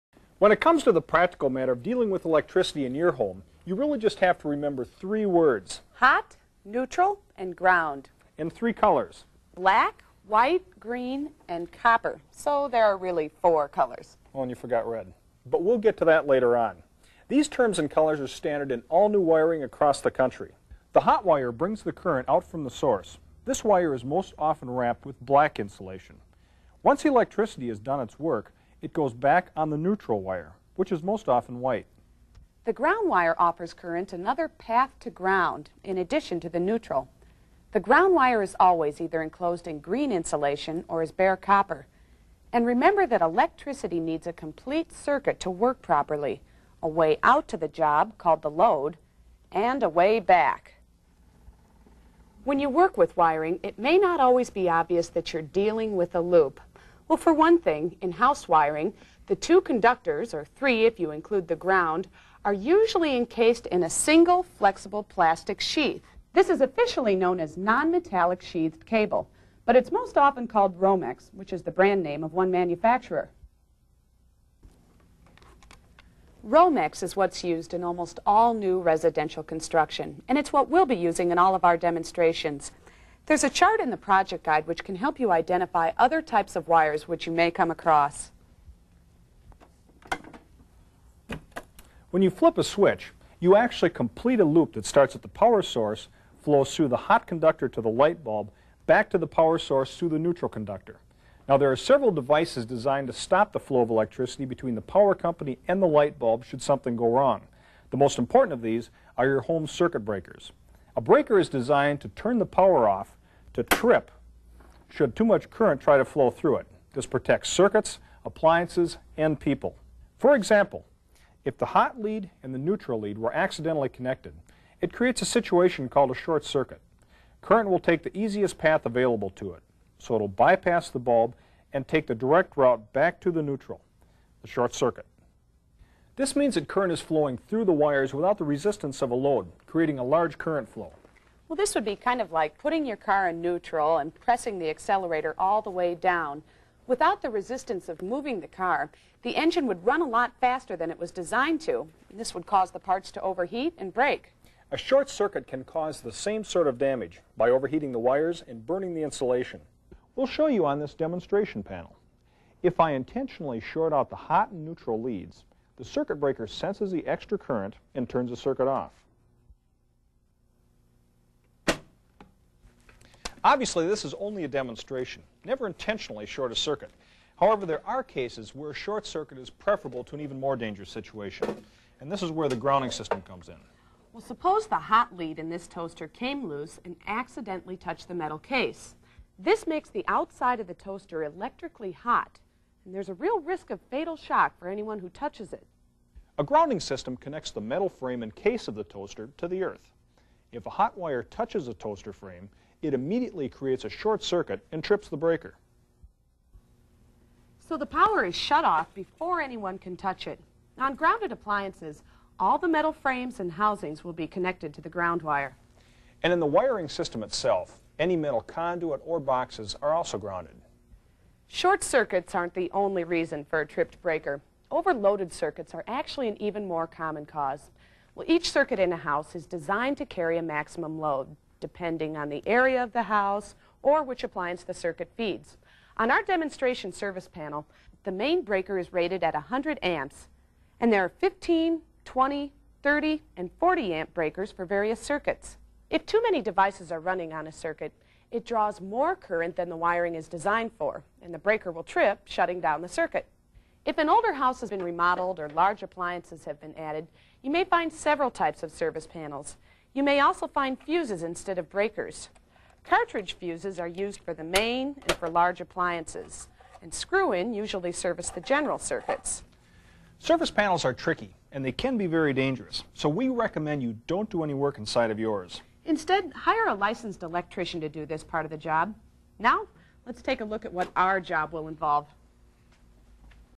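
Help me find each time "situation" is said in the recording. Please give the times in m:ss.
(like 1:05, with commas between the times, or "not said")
2:05, 3:00.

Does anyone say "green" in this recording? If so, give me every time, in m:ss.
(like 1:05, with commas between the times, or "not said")
0:10, 0:39.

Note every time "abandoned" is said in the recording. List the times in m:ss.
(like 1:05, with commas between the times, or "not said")
not said.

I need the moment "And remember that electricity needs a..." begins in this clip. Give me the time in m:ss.
0:42.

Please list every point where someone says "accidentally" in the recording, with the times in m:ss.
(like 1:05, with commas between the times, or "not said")
2:03, 3:07.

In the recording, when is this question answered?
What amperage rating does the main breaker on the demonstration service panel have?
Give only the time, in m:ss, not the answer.
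3:59.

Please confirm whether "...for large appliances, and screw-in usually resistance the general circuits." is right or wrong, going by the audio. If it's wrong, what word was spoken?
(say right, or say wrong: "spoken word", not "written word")
wrong: "service", not "resistance".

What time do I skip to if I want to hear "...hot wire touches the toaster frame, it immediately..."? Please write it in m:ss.
3:20.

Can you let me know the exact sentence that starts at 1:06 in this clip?
This is officially known as non-metallic sheathed cable, but it's most often called Romex, which is the brand name of one manufacturer.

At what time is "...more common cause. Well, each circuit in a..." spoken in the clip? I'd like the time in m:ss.
3:46.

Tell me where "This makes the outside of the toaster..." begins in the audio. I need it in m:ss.
3:09.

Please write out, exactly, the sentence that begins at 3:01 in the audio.
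And this is where the grounding system comes in.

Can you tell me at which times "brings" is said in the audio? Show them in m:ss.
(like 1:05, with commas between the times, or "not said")
0:21.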